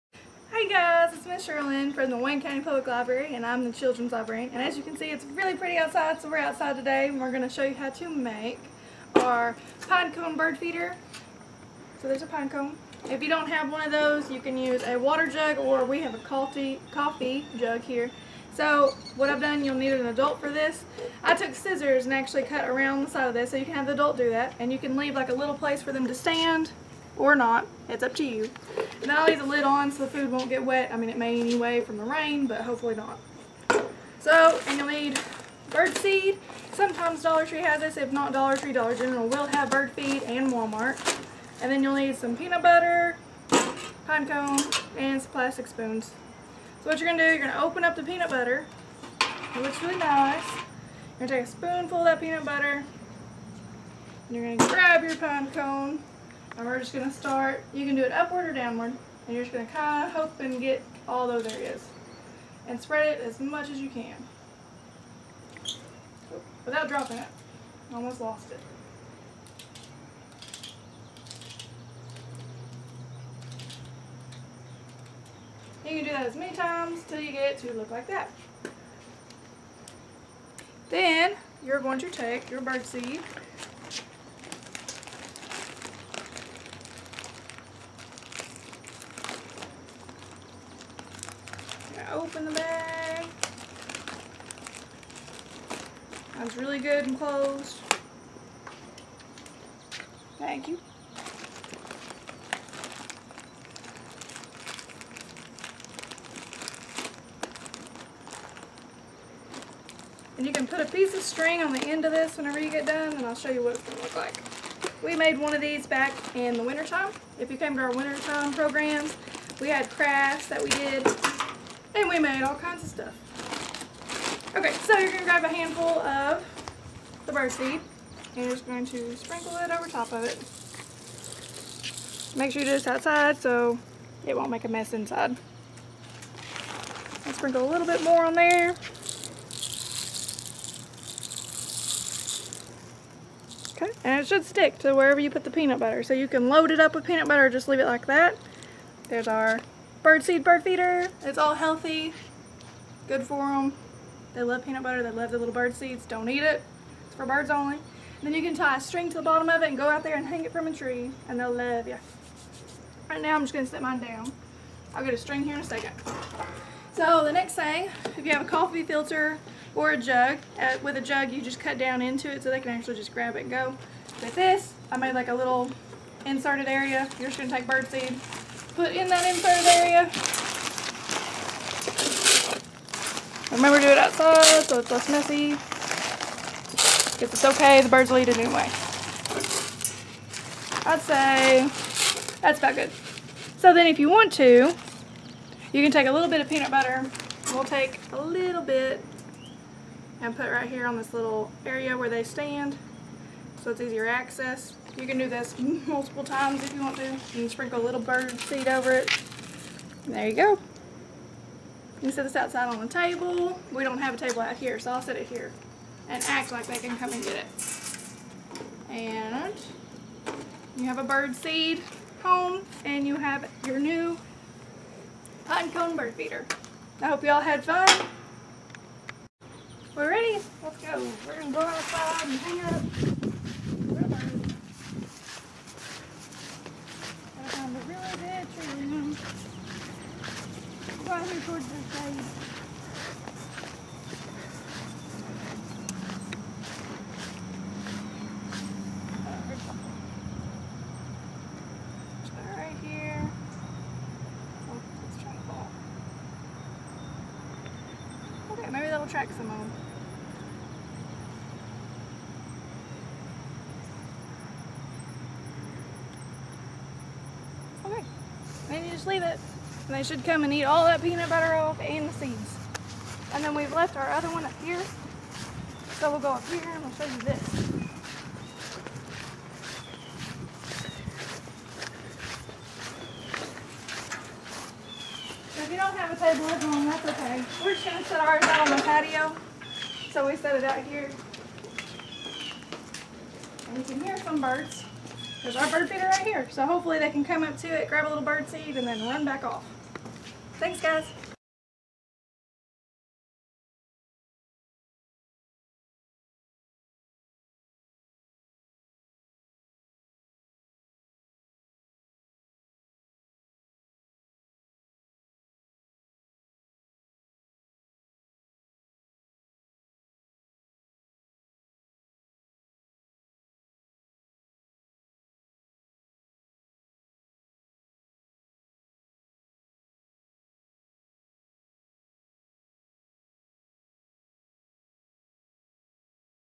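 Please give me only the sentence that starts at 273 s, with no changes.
And then we've left our other one up here.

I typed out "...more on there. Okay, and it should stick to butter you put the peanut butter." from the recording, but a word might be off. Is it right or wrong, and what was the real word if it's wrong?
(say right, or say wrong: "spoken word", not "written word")
wrong: "wherever", not "butter".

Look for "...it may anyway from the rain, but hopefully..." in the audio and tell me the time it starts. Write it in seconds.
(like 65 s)
31 s.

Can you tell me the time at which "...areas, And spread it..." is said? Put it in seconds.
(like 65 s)
61 s.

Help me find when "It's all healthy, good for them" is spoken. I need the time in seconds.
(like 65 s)
151 s.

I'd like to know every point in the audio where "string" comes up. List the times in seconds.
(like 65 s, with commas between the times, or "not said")
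111 s, 158 s, 165 s.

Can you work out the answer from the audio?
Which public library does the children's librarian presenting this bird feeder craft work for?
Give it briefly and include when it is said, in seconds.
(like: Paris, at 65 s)
Wayne County Public Library, at 2 s.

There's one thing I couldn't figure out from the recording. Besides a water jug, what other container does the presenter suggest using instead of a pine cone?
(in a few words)
coffee jug.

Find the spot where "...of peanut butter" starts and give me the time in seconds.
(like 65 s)
196 s.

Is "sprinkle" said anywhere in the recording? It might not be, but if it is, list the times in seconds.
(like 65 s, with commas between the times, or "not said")
129 s, 137 s, 207 s.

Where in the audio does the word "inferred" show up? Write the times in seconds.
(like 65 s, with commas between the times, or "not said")
179 s.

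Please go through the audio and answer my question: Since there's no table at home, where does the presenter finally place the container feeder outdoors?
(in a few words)
the patio.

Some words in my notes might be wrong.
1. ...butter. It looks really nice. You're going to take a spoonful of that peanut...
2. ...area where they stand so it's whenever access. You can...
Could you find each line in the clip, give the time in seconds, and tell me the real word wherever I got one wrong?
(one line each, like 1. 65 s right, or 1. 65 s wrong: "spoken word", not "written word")
1. 48 s right
2. 201 s wrong: "easier", not "whenever".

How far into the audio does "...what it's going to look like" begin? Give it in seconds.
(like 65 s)
113 s.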